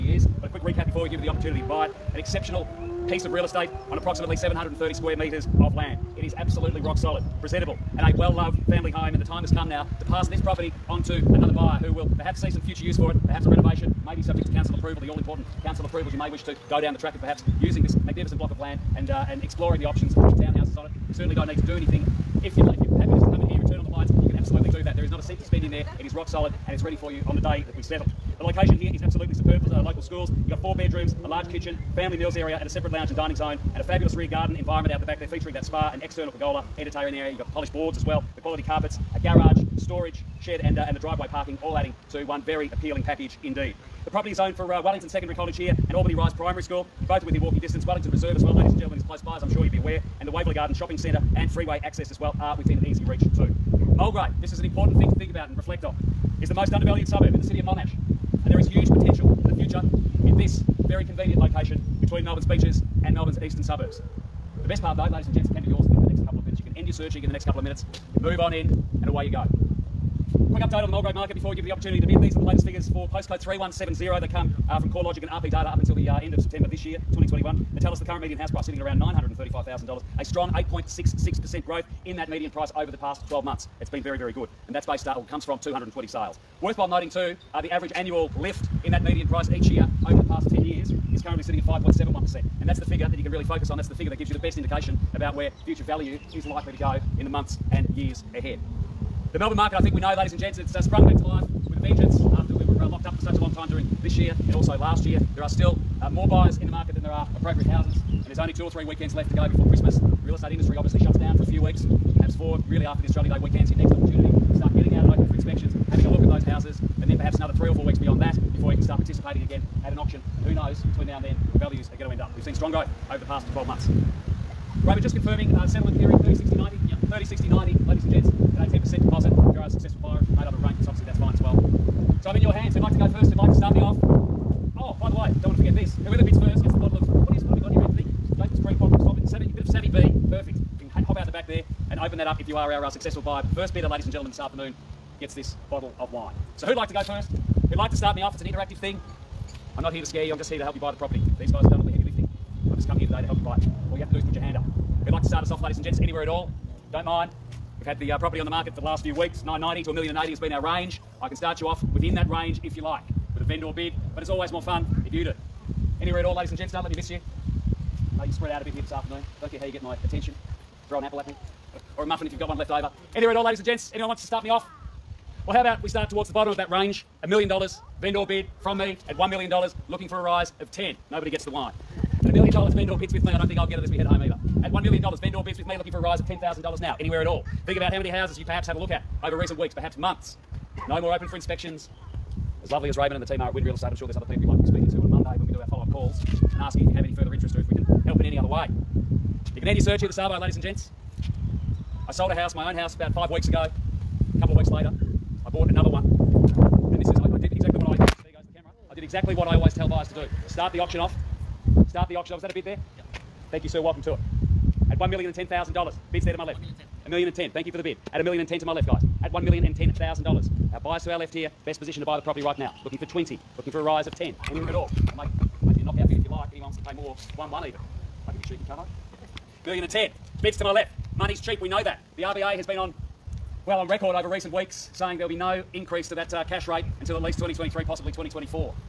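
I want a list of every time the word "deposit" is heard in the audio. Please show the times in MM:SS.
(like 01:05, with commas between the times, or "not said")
02:09.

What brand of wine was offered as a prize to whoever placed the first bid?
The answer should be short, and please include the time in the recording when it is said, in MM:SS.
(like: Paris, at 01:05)
Jacob's Creek, at 02:18.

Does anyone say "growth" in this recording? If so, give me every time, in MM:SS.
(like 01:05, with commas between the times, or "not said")
01:21, 02:02.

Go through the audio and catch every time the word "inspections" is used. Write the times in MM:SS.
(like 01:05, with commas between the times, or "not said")
01:55, 03:11.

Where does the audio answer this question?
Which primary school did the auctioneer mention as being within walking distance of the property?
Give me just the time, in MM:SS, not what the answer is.
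00:45.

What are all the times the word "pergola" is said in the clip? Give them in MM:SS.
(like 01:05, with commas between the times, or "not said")
00:36.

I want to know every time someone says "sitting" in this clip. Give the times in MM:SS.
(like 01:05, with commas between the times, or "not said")
01:18, 01:31.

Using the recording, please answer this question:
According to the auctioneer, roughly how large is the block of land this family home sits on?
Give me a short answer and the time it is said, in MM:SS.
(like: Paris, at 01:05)
730 square metres, at 00:04.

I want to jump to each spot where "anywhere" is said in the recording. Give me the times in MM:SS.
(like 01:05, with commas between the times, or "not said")
02:35, 02:46, 02:53, 03:06, 03:44.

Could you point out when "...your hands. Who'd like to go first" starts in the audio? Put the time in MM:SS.
02:12.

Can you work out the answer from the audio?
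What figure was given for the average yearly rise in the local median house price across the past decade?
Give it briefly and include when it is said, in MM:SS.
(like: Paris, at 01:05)
5.71%, at 01:31.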